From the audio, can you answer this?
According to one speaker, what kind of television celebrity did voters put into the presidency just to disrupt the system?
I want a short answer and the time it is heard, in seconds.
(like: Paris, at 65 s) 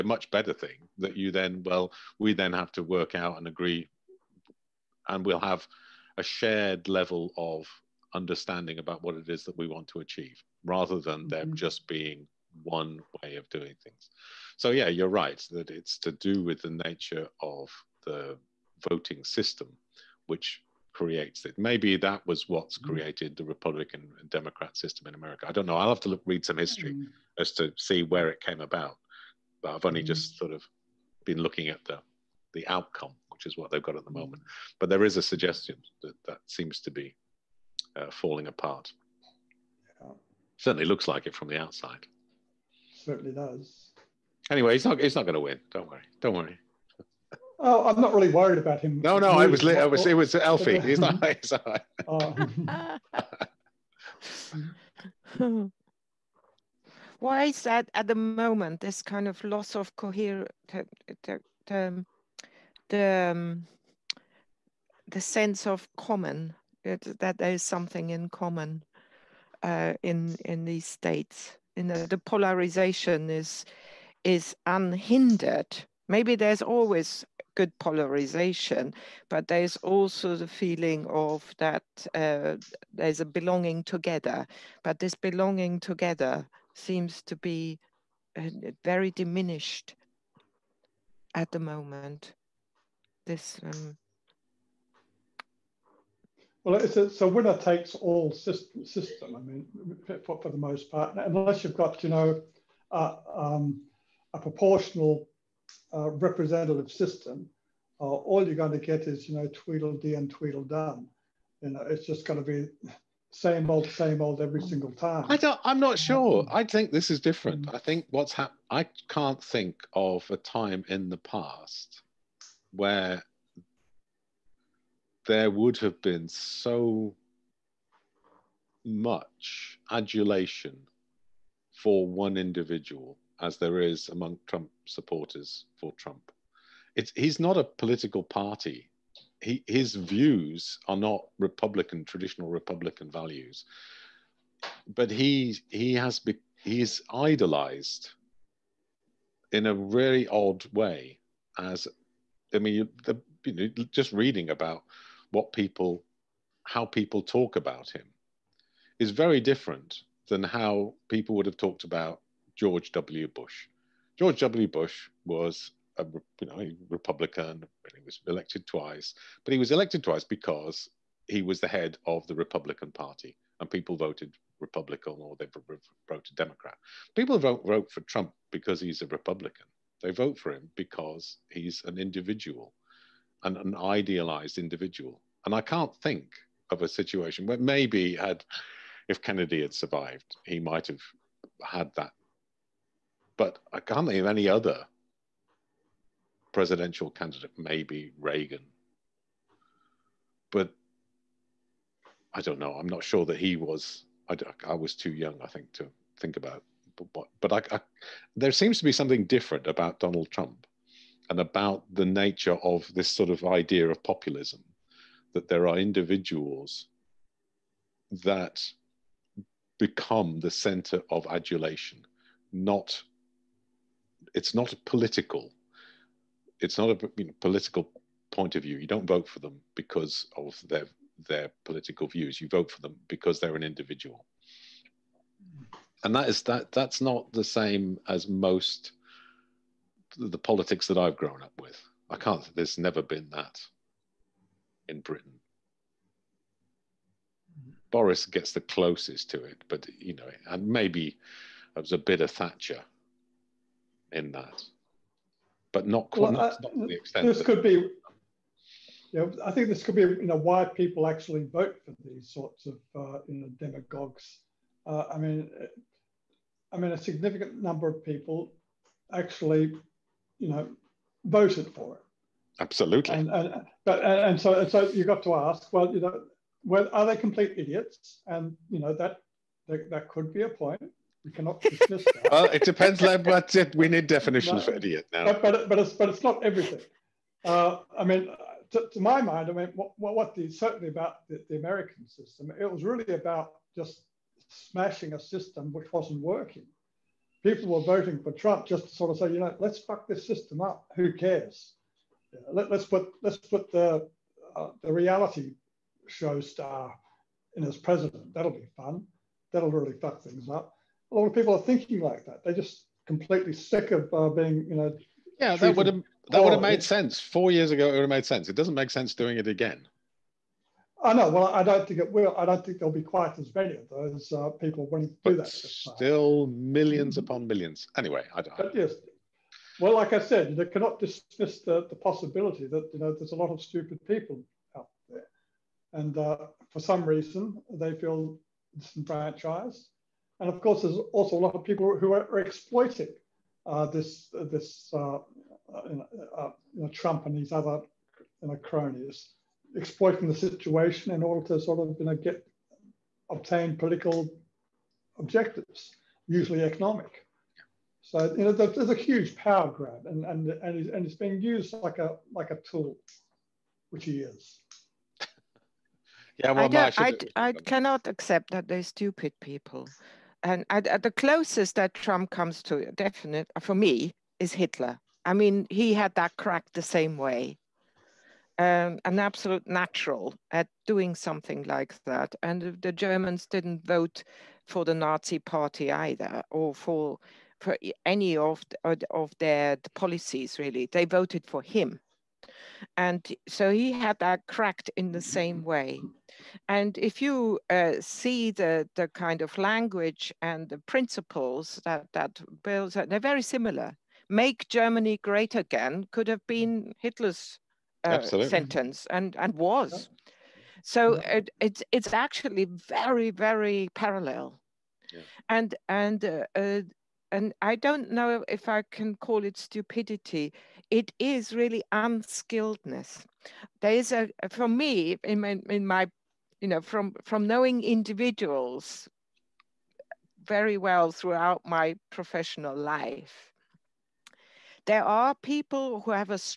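reality show star, at 304 s.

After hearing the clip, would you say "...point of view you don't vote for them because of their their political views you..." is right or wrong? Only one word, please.
right.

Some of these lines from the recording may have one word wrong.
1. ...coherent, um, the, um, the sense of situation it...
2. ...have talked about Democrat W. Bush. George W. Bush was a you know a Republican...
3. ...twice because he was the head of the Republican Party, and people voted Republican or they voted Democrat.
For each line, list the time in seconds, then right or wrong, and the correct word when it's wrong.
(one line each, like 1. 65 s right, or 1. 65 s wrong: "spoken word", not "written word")
1. 59 s wrong: "common", not "situation"
2. 161 s wrong: "George", not "Democrat"
3. 170 s right.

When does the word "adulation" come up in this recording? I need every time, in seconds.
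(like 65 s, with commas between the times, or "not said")
129 s, 221 s.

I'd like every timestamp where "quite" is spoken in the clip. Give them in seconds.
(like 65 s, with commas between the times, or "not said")
256 s, 323 s.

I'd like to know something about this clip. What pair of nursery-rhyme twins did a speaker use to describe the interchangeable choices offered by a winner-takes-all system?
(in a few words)
Tweedledee and Tweedledum.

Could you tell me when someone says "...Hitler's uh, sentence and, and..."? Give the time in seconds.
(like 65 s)
406 s.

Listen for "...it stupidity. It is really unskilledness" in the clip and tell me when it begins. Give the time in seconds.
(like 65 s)
419 s.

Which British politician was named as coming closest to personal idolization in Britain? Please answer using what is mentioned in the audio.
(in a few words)
Boris.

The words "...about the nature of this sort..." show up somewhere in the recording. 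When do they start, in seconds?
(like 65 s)
211 s.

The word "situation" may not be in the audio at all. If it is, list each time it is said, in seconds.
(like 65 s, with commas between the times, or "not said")
186 s, 350 s.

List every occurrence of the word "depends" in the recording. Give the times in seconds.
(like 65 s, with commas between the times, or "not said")
282 s.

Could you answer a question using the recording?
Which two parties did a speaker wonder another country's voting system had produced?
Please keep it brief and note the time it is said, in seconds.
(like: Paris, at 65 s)
Republican and Democrat, at 23 s.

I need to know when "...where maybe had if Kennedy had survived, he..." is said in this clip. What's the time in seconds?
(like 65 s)
187 s.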